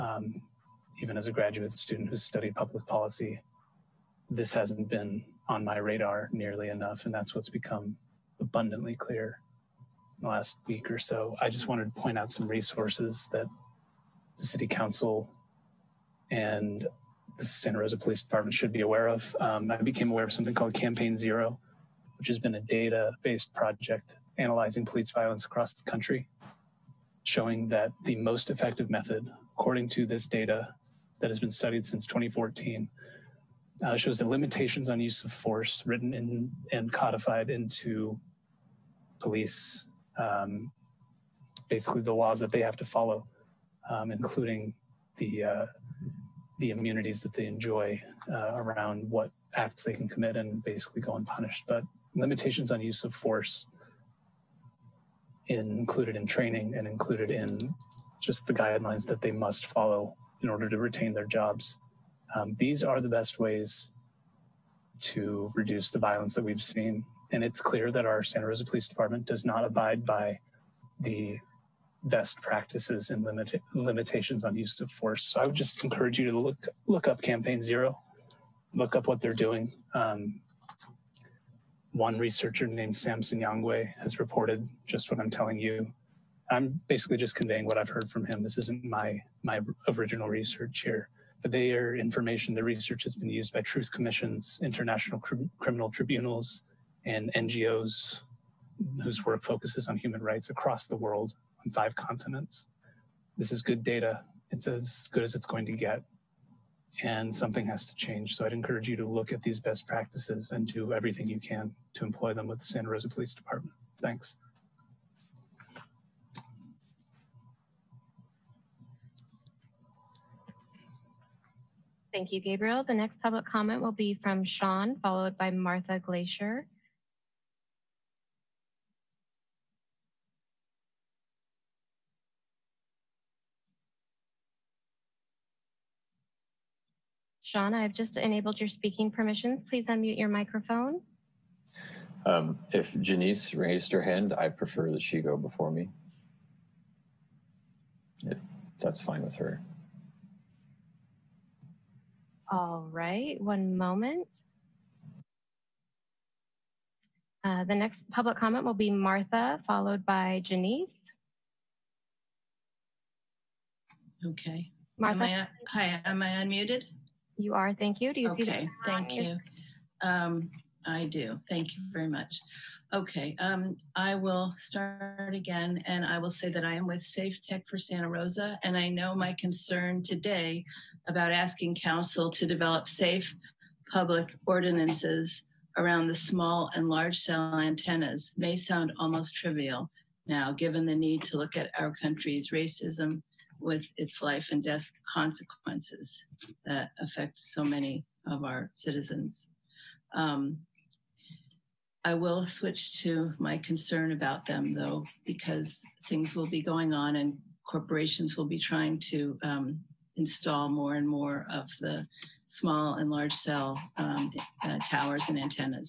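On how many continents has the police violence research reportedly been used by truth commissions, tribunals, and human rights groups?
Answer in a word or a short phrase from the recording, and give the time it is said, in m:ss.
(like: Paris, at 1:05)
5, at 1:41.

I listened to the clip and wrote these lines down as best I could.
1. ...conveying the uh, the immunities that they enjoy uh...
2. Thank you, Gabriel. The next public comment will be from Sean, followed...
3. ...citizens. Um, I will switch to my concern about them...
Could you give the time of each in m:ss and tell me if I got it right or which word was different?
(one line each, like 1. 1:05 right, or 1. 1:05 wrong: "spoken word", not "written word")
1. 0:44 wrong: "including", not "conveying"
2. 2:02 right
3. 3:18 right.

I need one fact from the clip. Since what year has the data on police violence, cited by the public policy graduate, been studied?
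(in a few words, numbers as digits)
2014.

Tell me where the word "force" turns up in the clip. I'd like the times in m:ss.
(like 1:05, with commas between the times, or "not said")
0:35, 0:53, 1:14.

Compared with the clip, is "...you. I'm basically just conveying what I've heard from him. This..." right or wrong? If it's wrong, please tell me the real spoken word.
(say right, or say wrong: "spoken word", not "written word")
right.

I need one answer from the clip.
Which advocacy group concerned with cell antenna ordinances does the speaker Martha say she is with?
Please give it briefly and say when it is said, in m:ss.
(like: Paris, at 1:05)
Safe Tech for Santa Rosa, at 2:57.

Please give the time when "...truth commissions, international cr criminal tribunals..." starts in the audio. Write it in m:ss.
1:33.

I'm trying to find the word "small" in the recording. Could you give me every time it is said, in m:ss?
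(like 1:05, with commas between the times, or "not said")
3:06, 3:32.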